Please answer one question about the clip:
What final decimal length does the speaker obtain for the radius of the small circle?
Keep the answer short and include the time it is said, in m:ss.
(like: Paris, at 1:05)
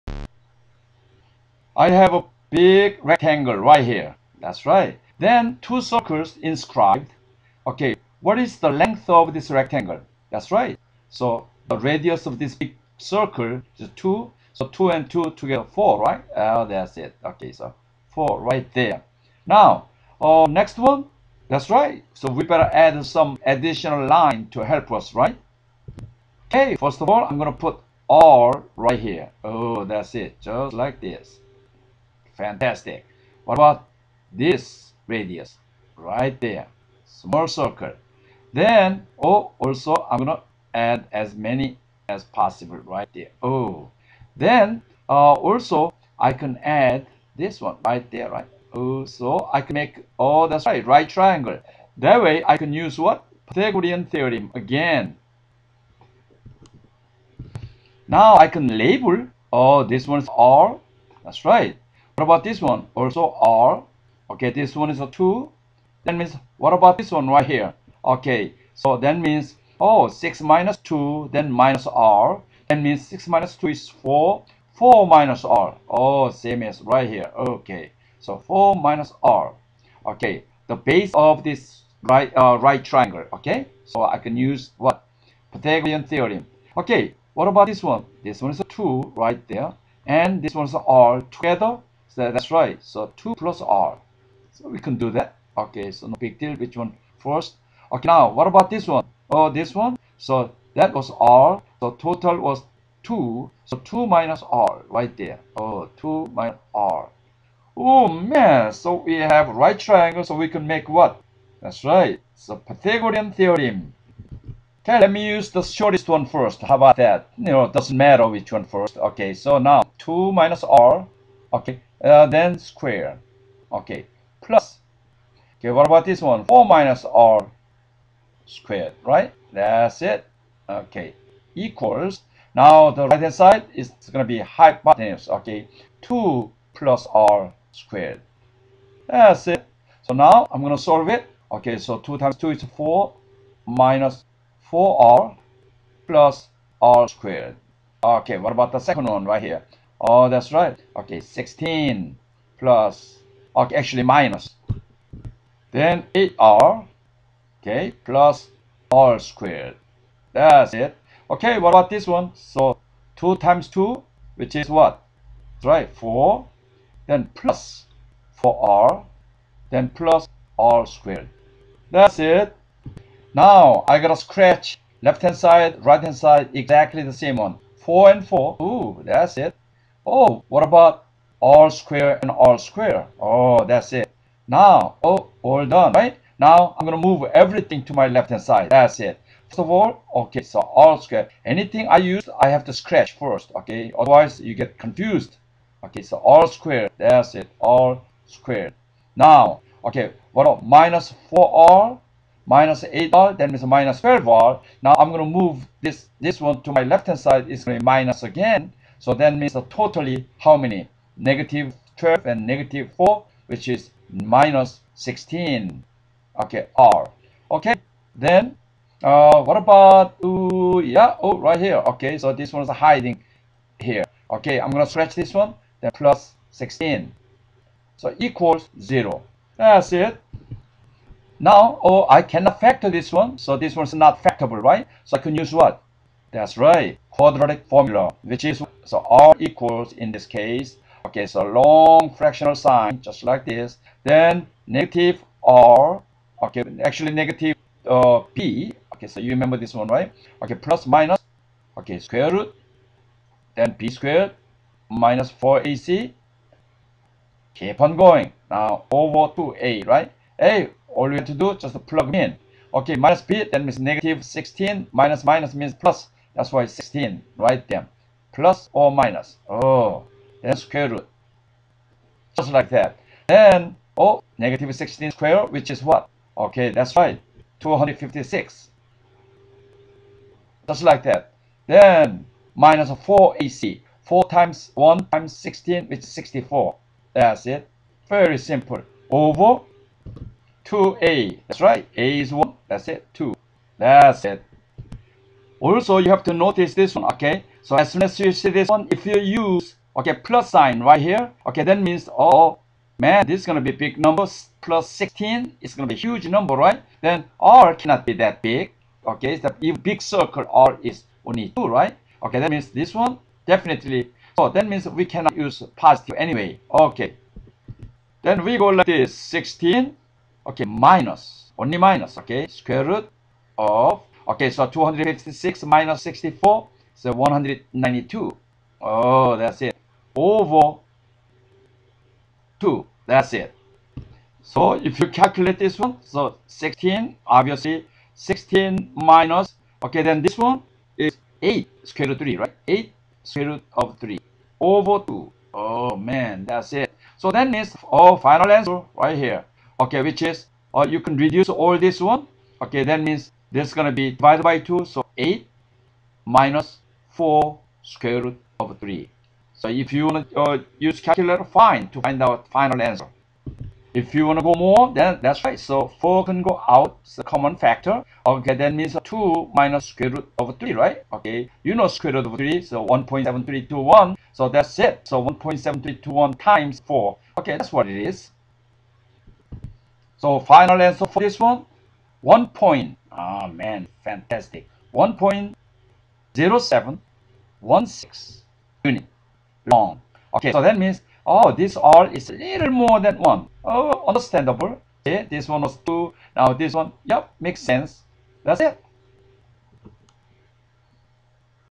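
1.0716, at 6:24.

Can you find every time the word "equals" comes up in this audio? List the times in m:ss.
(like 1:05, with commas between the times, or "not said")
2:11, 3:48, 3:59.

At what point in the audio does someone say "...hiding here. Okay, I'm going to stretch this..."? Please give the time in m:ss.
3:42.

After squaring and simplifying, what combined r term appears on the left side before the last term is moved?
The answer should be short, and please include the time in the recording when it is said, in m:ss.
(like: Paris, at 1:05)
-12r, at 3:23.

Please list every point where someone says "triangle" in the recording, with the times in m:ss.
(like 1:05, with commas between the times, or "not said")
0:51, 1:22, 1:49.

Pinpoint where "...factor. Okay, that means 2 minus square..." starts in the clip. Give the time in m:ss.
6:07.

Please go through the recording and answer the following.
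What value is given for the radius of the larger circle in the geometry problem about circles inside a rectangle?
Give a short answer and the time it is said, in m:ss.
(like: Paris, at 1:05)
2, at 0:11.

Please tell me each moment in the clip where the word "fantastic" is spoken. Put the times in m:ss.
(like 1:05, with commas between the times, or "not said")
0:32, 6:24.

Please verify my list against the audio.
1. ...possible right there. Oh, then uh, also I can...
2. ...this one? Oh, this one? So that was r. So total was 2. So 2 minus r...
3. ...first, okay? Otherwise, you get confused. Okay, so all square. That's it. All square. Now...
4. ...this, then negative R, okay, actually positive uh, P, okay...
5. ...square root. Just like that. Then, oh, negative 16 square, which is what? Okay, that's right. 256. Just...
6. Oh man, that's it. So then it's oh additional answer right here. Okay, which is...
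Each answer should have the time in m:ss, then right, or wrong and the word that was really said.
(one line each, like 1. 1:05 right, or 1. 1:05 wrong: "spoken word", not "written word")
1. 0:42 right
2. 1:38 right
3. 3:13 right
4. 4:03 wrong: "negative", not "positive"
5. 4:30 right
6. 5:45 wrong: "final", not "additional".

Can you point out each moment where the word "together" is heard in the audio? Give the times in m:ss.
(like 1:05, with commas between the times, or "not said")
0:15, 1:31.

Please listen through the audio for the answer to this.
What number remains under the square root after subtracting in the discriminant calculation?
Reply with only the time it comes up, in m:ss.
5:27.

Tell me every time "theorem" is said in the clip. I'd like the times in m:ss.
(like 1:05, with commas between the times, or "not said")
0:54, 1:26, 1:53.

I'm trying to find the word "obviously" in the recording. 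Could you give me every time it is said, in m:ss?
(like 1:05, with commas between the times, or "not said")
5:37.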